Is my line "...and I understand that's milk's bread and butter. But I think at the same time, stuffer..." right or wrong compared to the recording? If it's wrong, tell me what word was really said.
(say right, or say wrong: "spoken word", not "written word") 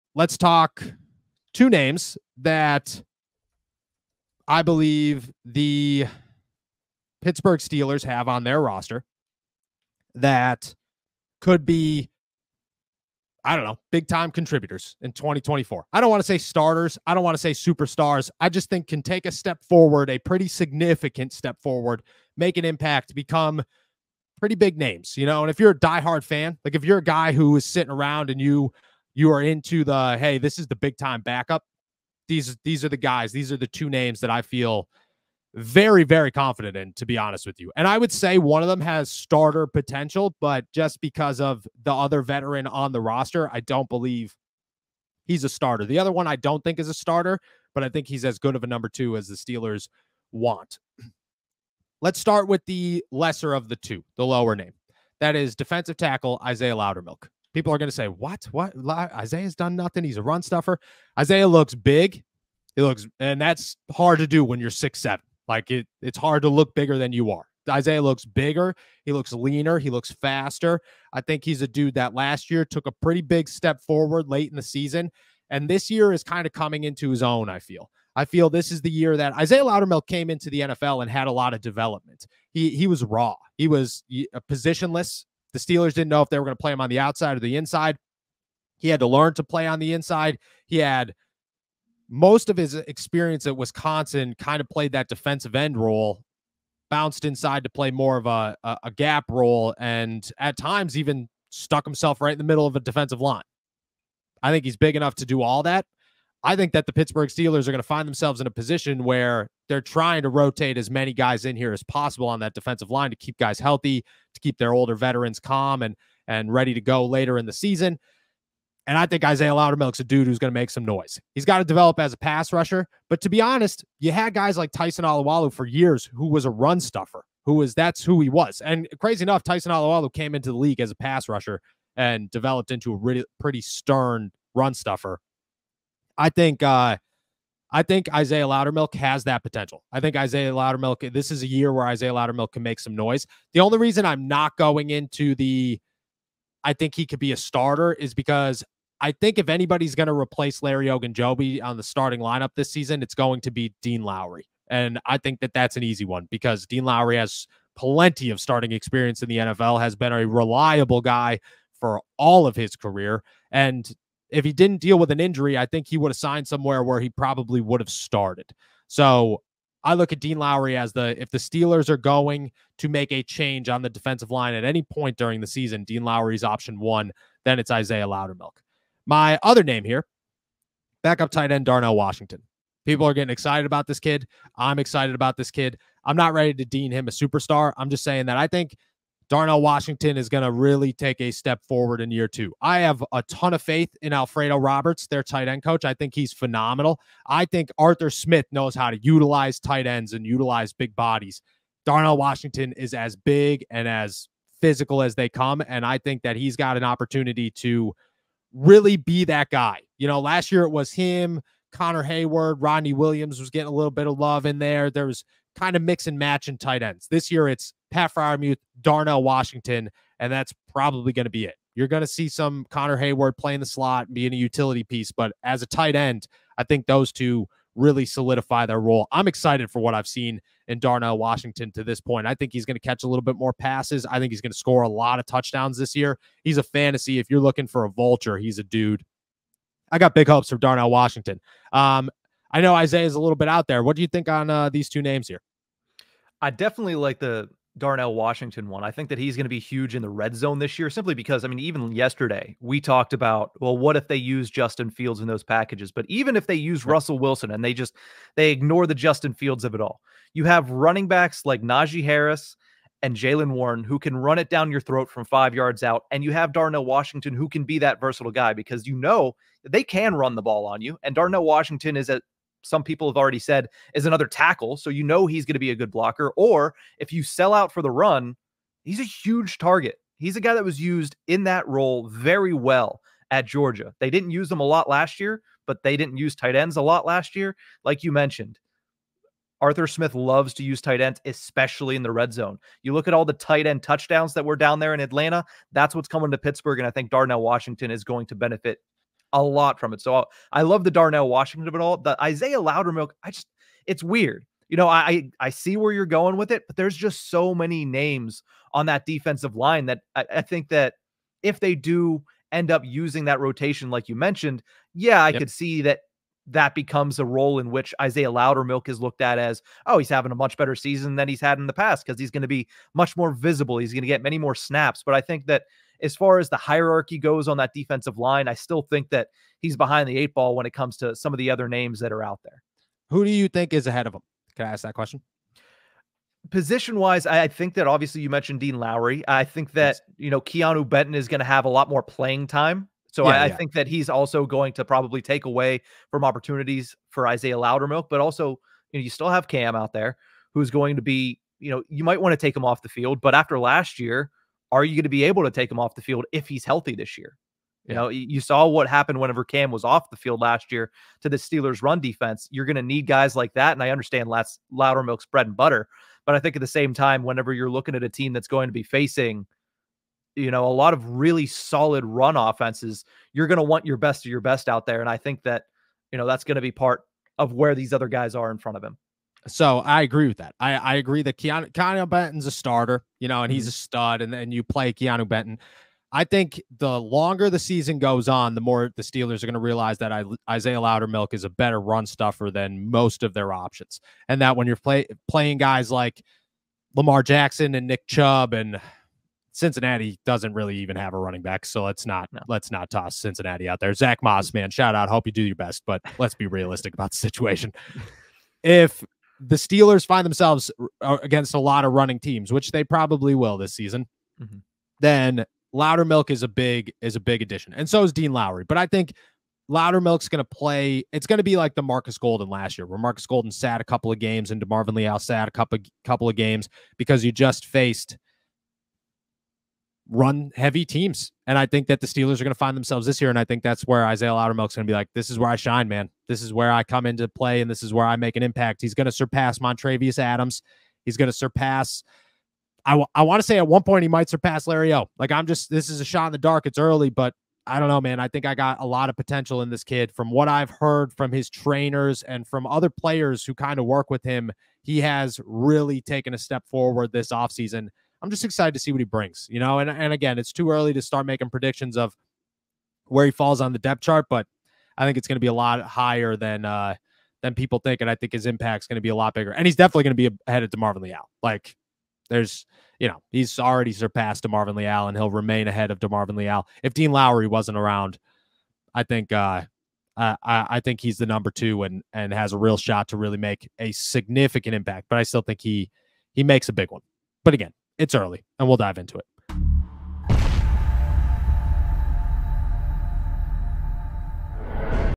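wrong: "whenever", not "stuffer".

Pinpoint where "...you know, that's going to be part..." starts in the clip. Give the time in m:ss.
6:16.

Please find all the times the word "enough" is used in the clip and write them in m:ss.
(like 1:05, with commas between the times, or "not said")
1:44, 2:09.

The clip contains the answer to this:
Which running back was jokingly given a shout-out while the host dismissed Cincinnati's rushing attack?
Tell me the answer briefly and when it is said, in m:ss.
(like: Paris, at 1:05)
Zach Moss, at 6:43.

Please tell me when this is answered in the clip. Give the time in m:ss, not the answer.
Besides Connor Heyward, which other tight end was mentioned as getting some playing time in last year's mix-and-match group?
3:32.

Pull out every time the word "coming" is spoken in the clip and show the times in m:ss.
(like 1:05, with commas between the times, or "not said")
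1:16, 4:56.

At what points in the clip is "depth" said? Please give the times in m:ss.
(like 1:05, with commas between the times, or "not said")
7:43.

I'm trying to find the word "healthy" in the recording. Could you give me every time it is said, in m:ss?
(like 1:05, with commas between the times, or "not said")
1:53, 5:56.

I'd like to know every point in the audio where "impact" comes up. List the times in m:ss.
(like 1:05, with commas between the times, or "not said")
0:22, 7:18, 7:48, 8:04.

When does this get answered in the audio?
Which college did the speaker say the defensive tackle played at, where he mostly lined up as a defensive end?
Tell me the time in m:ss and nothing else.
1:33.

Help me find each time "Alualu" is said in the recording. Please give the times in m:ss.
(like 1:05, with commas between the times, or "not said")
2:05, 2:09.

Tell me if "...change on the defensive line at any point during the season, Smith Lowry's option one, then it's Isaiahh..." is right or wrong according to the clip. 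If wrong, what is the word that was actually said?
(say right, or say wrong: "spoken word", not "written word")
wrong: "Dean", not "Smith".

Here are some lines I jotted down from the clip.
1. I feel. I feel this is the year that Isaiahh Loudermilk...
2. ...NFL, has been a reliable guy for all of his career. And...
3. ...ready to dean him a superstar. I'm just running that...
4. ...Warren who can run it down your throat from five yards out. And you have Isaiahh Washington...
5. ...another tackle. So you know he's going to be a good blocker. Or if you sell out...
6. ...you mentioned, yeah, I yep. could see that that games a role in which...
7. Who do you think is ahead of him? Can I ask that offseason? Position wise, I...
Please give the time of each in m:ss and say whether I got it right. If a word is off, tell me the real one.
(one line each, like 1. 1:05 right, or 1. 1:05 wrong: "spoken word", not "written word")
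1. 1:17 right
2. 2:39 right
3. 3:06 wrong: "saying", not "running"
4. 4:23 wrong: "Darnell", not "Isaiahh"
5. 4:34 right
6. 5:14 wrong: "becomes", not "games"
7. 5:33 wrong: "question", not "offseason".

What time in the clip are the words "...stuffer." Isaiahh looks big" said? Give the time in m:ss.
1:00.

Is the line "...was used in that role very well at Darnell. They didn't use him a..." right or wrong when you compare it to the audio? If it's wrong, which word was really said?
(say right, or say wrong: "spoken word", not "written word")
wrong: "Georgia", not "Darnell".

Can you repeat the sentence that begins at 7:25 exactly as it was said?
Like, I'm just, this is a shot in the dark.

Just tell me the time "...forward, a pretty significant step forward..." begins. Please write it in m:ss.
0:19.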